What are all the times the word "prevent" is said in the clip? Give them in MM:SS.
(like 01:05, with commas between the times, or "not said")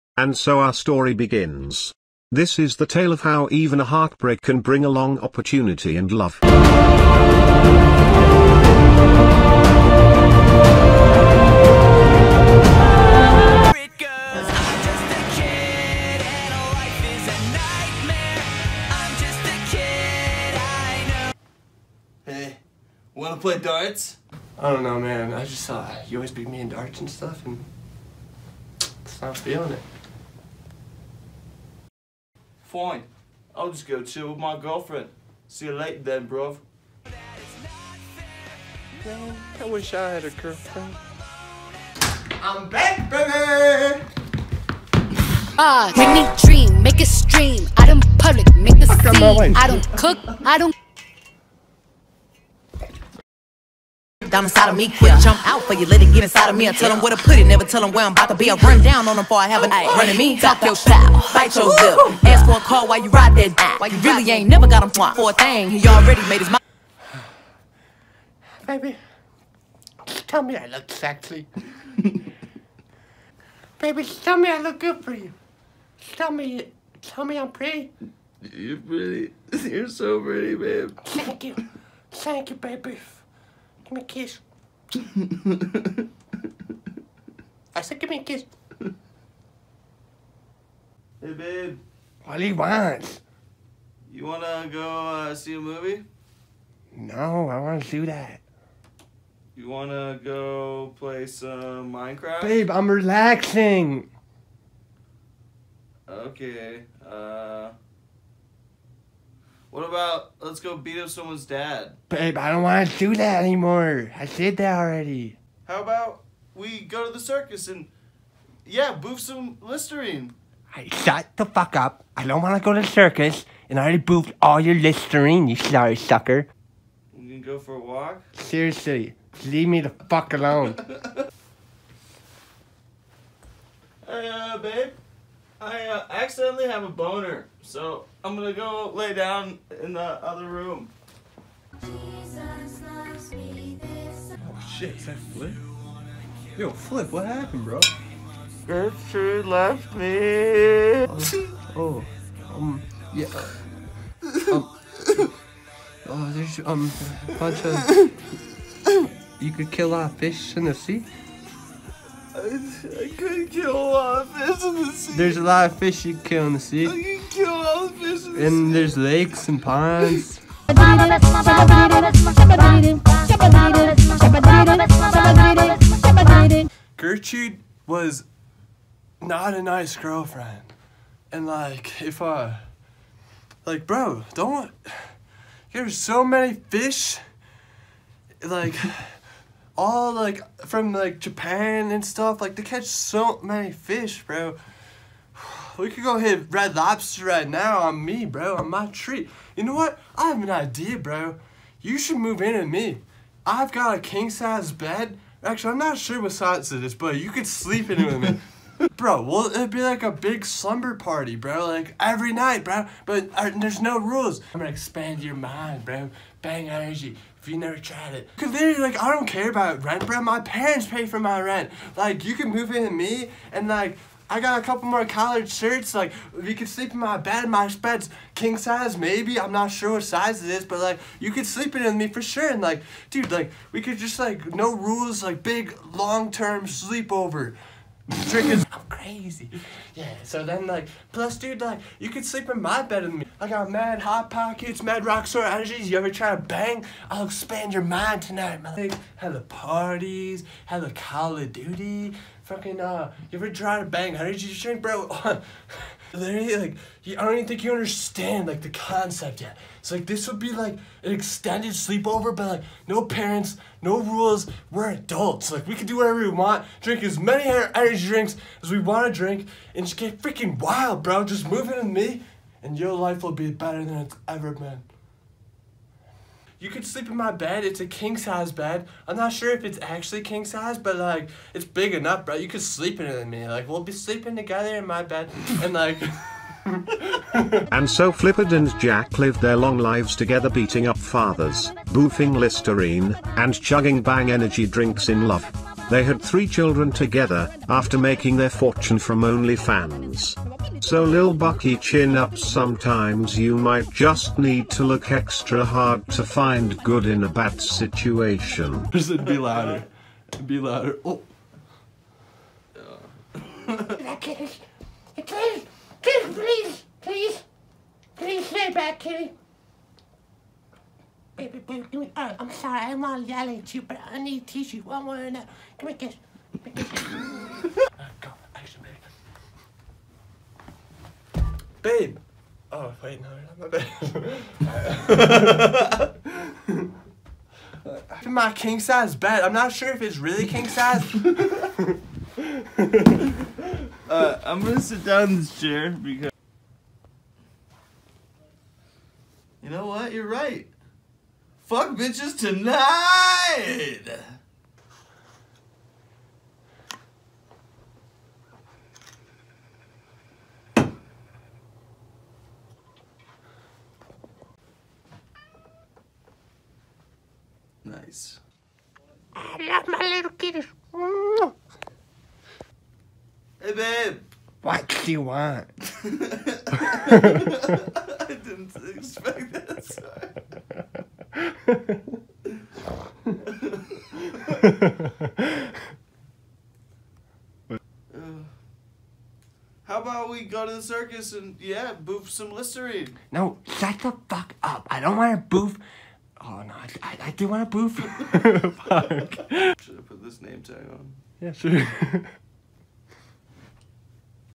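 not said.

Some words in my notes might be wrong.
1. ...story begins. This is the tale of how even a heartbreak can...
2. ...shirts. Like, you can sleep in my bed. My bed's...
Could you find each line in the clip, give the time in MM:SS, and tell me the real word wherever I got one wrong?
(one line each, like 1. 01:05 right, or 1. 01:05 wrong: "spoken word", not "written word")
1. 00:00 right
2. 03:45 right.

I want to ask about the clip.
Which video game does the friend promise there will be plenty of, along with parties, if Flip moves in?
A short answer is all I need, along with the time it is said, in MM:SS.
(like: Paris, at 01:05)
Call of Duty, at 04:10.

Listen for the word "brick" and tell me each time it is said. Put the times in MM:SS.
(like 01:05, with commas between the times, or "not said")
not said.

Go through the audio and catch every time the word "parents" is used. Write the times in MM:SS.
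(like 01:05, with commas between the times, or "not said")
03:40, 04:23.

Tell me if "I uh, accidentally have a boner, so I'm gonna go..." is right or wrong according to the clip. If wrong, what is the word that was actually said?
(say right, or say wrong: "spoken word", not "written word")
right.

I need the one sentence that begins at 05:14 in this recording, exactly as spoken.
kitty, kitty, please, please, please stay back, kitty.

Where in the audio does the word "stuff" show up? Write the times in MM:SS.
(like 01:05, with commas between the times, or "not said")
00:27, 03:12.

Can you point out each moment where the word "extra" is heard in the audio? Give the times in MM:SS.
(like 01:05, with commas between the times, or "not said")
05:05.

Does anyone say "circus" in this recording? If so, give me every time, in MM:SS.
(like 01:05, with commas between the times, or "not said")
01:57, 02:02, 06:30.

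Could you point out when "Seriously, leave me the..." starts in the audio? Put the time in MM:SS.
02:08.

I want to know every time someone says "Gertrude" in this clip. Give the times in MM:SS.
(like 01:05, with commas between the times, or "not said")
02:28, 02:56.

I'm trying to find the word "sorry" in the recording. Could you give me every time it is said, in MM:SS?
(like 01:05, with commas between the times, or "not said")
02:05, 05:22.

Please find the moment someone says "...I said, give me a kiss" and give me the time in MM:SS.
01:27.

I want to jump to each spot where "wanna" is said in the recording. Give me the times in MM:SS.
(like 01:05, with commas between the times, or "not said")
00:23.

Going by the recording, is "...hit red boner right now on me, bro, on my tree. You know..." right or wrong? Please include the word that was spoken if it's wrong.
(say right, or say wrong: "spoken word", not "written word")
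wrong: "lobster", not "boner".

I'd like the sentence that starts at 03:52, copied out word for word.
And like, dude, like, we could just like, no rules, like, big long term sleepover.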